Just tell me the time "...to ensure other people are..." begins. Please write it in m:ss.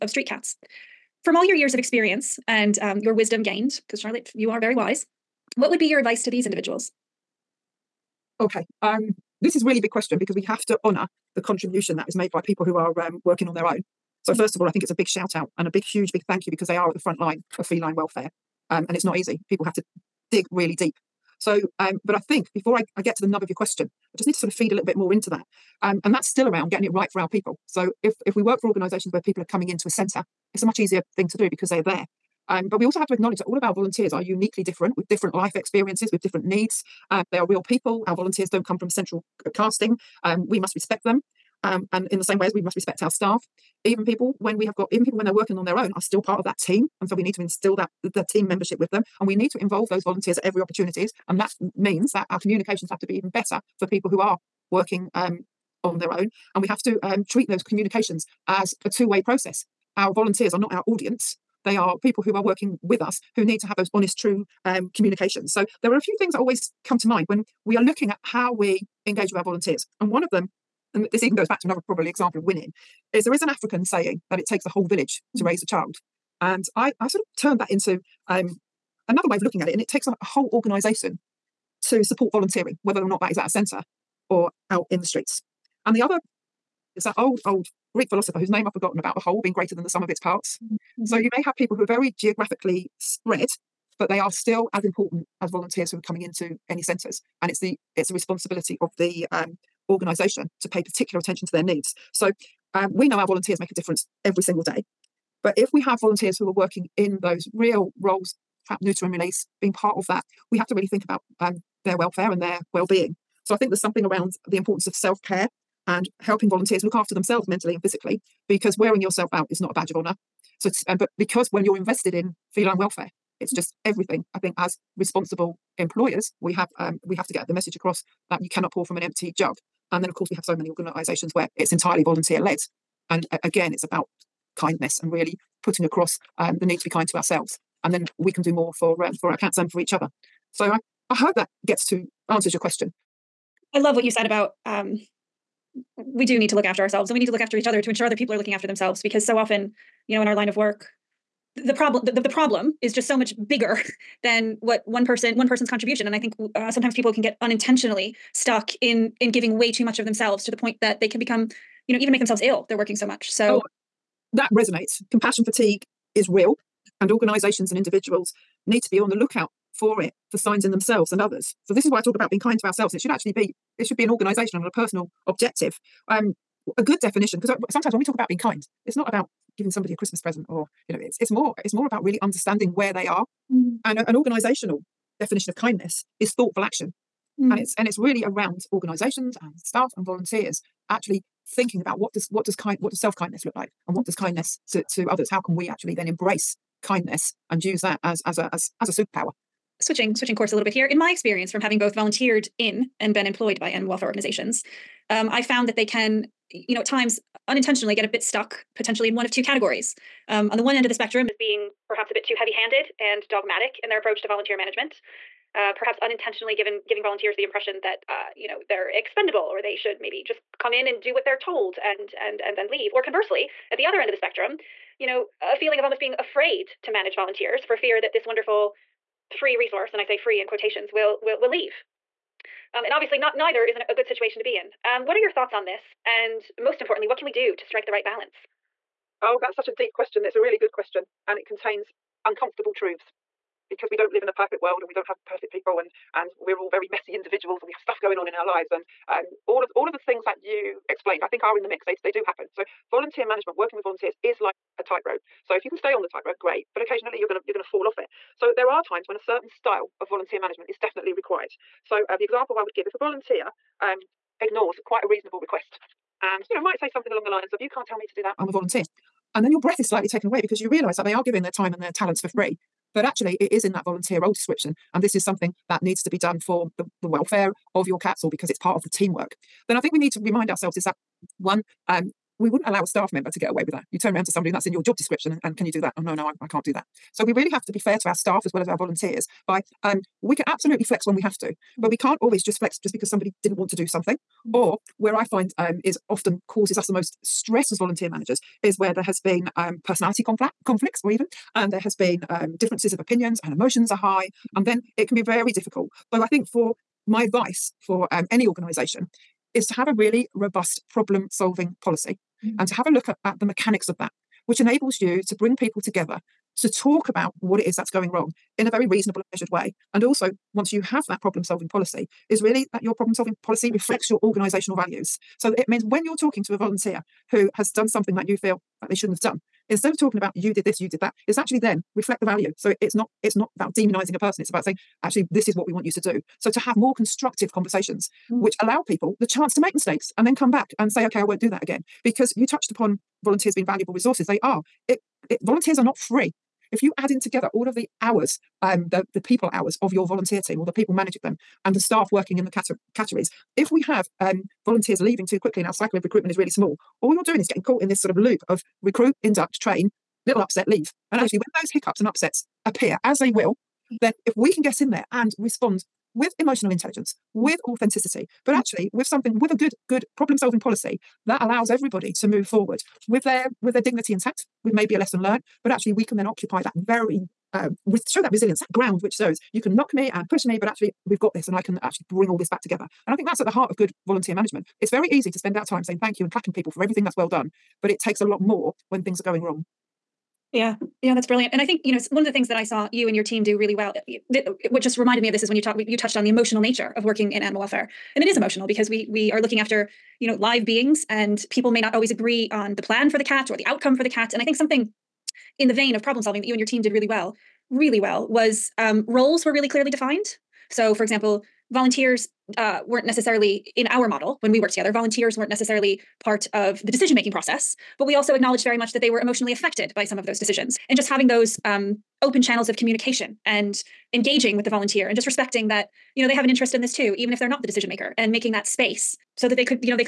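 2:27.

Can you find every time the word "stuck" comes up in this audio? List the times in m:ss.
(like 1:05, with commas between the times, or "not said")
2:38, 3:28.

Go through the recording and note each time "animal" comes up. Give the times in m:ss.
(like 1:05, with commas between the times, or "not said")
3:23, 6:37.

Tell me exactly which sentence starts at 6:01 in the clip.
And actually, when those hiccups and upsets appear, as they will, mm.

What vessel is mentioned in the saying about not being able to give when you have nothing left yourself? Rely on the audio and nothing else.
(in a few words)
An empty jug.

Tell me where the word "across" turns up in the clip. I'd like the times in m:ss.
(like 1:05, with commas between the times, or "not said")
2:07, 2:15.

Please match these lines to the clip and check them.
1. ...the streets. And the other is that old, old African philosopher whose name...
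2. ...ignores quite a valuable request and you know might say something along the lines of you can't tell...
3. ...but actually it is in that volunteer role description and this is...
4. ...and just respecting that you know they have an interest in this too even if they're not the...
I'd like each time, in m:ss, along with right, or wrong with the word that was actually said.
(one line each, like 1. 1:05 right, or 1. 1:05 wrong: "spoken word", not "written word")
1. 1:25 wrong: "Greek", not "African"
2. 4:24 wrong: "reasonable", not "valuable"
3. 4:32 right
4. 7:05 right.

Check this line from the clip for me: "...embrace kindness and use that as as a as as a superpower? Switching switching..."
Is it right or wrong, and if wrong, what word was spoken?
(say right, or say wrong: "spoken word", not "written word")
right.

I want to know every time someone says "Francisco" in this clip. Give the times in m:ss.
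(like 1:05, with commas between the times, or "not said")
not said.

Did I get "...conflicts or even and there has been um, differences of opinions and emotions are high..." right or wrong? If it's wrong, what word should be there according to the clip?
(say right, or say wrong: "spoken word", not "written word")
right.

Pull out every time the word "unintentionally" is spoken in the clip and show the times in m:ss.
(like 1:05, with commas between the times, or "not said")
2:37, 3:27, 3:36.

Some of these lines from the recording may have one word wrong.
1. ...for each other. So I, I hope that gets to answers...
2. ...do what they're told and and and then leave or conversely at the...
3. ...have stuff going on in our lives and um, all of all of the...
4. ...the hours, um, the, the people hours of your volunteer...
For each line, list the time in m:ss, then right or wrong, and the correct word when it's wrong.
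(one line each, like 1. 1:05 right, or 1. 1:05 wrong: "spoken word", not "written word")
1. 2:19 right
2. 3:41 right
3. 4:07 right
4. 5:47 right.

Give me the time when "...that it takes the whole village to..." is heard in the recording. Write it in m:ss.
1:14.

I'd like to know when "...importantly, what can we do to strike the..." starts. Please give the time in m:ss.
3:56.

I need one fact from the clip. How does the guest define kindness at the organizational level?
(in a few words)
Thoughtful action.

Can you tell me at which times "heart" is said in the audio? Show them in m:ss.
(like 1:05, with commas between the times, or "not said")
6:23.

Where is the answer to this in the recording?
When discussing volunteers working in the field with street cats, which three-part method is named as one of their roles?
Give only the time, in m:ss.
1:48.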